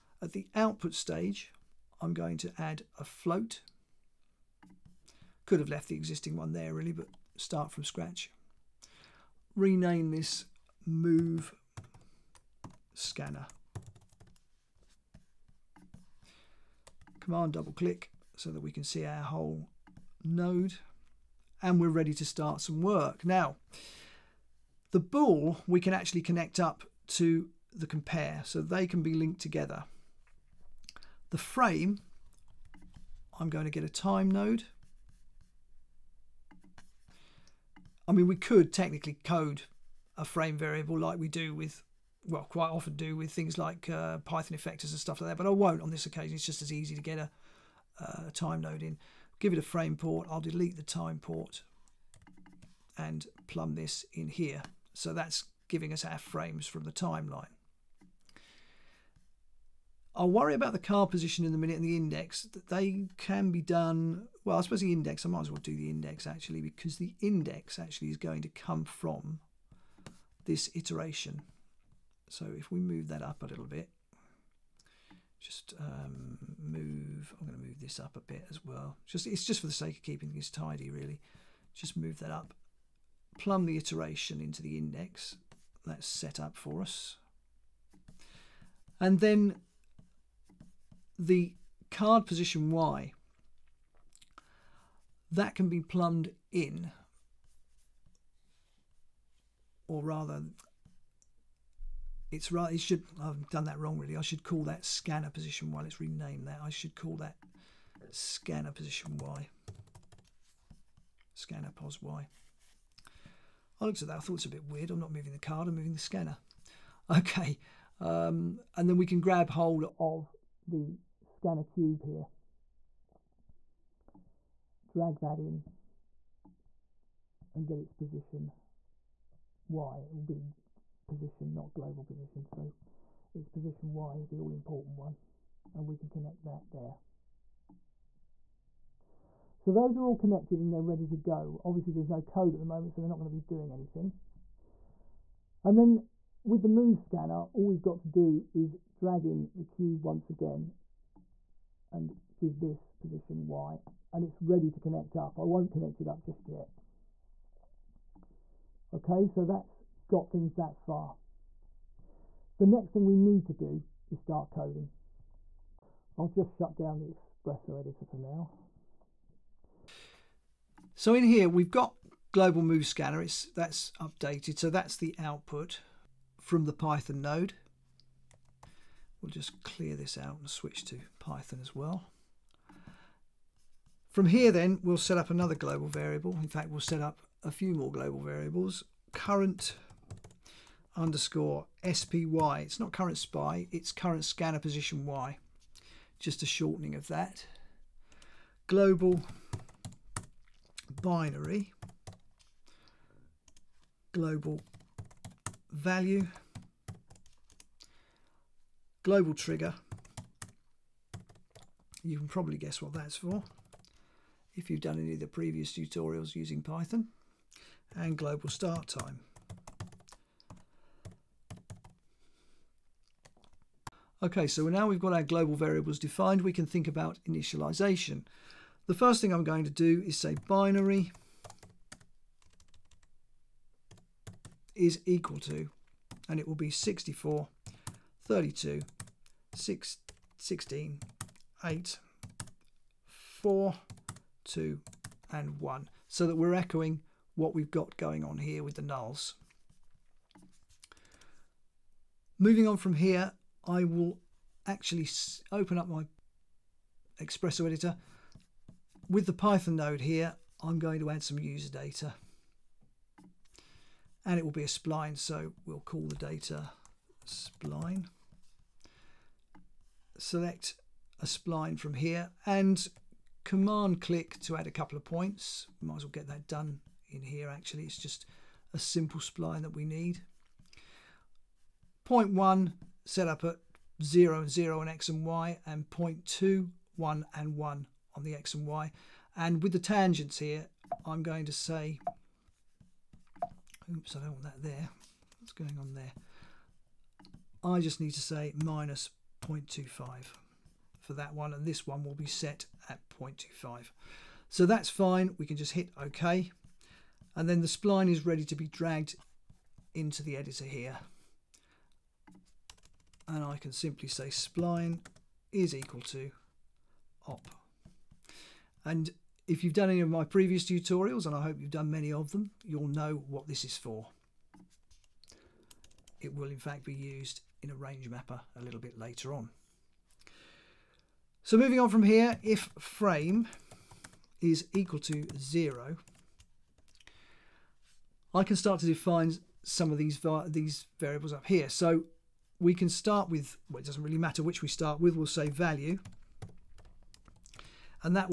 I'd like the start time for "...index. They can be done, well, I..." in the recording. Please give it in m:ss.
1:01.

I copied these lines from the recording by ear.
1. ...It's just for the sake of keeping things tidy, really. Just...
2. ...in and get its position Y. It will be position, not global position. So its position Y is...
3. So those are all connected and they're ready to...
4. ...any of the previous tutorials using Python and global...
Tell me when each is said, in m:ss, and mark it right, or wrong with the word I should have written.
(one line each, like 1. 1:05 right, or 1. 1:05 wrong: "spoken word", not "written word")
1. 1:19 right
2. 2:05 right
3. 2:19 right
4. 3:34 right.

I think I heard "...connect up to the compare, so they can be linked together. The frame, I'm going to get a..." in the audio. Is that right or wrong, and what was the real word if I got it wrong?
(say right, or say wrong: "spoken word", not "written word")
right.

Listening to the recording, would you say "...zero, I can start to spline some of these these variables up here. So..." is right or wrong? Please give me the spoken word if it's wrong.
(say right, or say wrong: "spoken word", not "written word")
wrong: "define", not "spline".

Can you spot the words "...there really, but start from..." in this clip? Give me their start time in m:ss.
0:06.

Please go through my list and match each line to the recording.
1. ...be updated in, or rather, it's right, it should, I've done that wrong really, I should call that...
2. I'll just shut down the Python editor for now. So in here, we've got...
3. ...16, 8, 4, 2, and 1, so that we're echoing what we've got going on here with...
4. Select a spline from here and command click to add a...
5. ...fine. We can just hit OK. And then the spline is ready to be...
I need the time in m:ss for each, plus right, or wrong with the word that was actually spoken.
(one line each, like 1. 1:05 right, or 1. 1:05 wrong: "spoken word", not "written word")
1. 1:35 wrong: "plumbed", not "updated"
2. 2:46 wrong: "Xpresso", not "Python"
3. 4:00 right
4. 4:30 right
5. 5:04 right.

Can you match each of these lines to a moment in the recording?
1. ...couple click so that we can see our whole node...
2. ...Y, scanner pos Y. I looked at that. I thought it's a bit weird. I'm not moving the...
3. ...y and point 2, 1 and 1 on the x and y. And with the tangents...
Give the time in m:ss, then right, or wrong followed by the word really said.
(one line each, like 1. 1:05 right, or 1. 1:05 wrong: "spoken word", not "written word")
1. 0:17 wrong: "double", not "couple"
2. 1:49 right
3. 4:45 right.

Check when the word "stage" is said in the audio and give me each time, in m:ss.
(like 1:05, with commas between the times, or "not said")
0:00.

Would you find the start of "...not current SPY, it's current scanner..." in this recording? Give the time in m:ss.
3:12.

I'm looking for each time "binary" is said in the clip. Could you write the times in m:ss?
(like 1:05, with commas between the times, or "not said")
3:21, 3:50.